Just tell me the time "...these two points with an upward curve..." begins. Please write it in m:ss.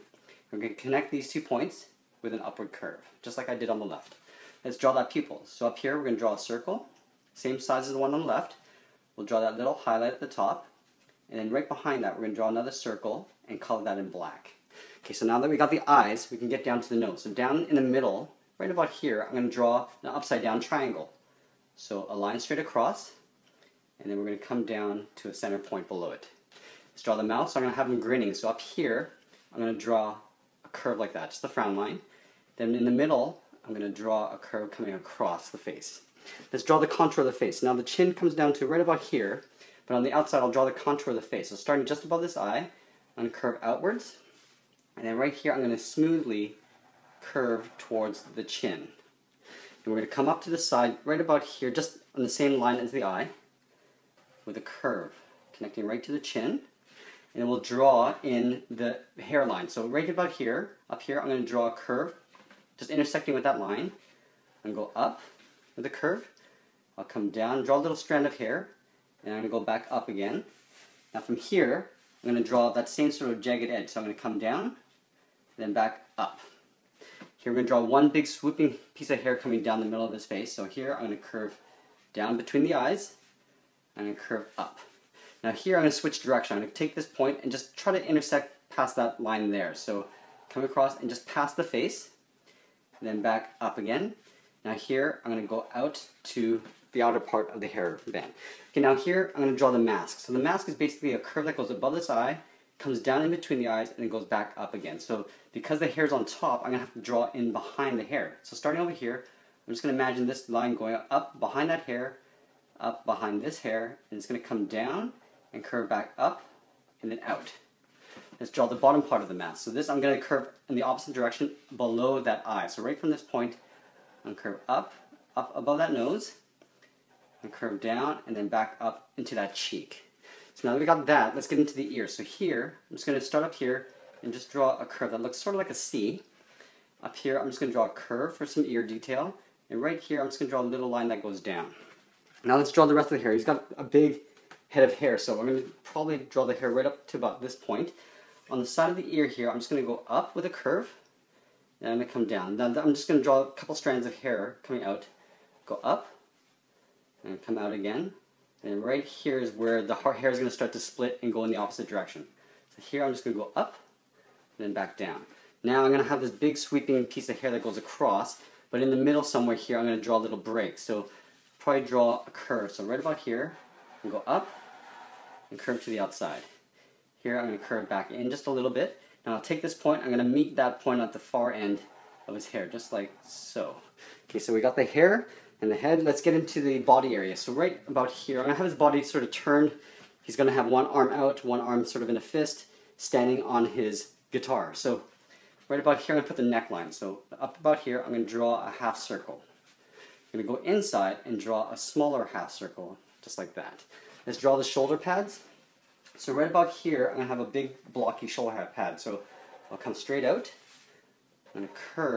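0:01.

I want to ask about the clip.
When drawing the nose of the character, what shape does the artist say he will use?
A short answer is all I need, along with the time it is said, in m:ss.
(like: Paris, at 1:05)
upside down triangle, at 0:20.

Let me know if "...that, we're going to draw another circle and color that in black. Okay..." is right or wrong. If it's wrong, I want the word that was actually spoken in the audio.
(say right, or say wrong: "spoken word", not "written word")
right.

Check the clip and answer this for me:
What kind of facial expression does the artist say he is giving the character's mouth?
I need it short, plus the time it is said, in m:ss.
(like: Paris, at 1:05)
grinning, at 0:27.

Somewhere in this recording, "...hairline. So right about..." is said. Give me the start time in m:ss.
0:59.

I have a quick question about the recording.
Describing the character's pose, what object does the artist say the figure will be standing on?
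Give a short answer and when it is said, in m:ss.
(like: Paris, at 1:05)
his guitar, at 3:13.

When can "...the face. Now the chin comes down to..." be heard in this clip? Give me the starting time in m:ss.
0:37.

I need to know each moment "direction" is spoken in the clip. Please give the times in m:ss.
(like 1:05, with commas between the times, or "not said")
1:26, 2:01, 2:41.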